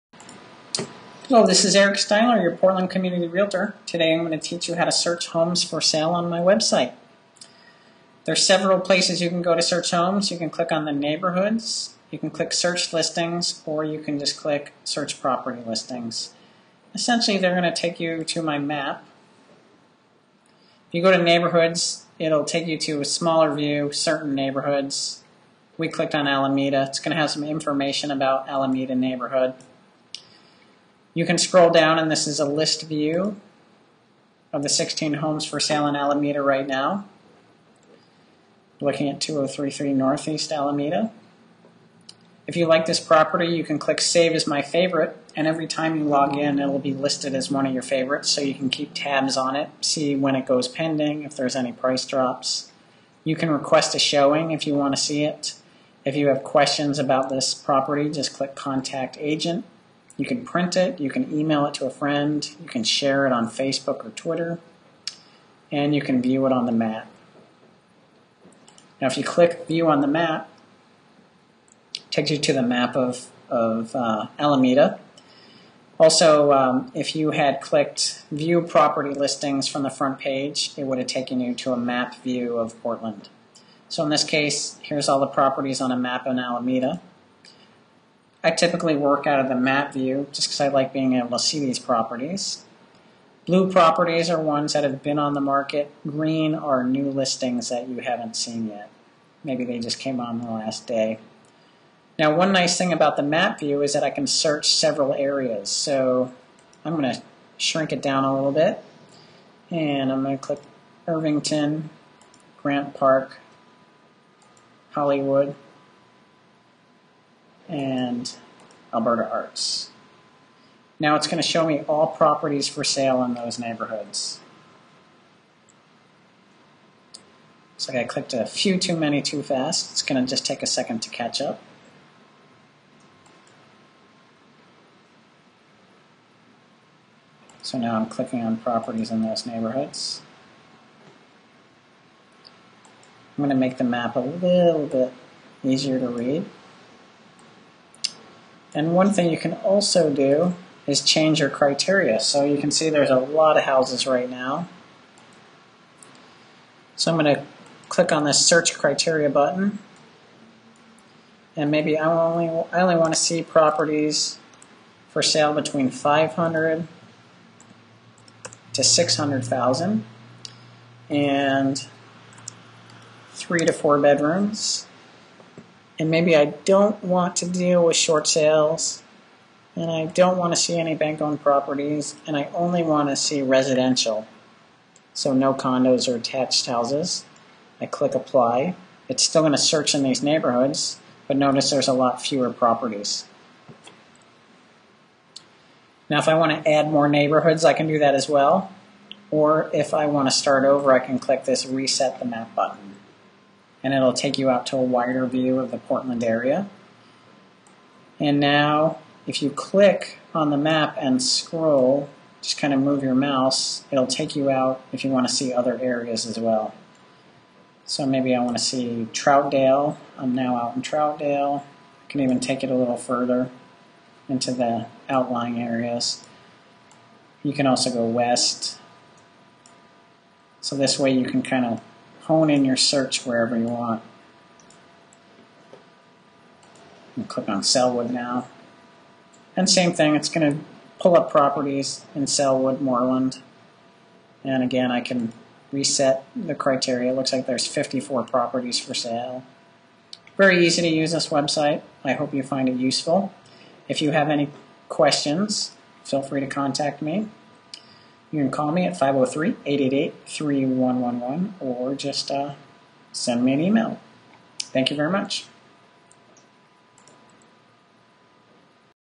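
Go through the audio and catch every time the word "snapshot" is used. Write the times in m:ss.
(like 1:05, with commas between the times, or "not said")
not said.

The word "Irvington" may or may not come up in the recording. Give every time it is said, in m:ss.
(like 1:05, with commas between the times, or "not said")
1:51.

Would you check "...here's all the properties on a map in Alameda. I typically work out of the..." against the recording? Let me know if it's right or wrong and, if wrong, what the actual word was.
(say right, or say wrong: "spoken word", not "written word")
right.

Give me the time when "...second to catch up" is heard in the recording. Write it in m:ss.
2:10.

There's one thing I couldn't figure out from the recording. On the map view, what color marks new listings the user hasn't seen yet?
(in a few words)
Green.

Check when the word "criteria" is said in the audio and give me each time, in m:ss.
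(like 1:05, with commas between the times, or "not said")
2:31, 2:38, 4:06.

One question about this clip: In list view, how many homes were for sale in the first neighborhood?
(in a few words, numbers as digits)
16.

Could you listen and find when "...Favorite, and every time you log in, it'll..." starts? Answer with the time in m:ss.
0:44.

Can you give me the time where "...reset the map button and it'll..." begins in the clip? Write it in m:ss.
3:21.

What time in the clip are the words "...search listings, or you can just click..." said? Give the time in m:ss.
0:12.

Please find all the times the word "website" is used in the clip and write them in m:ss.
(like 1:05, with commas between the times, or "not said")
0:06, 4:11.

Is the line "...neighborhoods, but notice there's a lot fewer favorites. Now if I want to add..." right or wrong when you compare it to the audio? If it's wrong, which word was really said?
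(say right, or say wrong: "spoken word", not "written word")
wrong: "properties", not "favorites".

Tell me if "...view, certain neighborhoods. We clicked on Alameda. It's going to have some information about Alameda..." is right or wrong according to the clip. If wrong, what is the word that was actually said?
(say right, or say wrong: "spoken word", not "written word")
right.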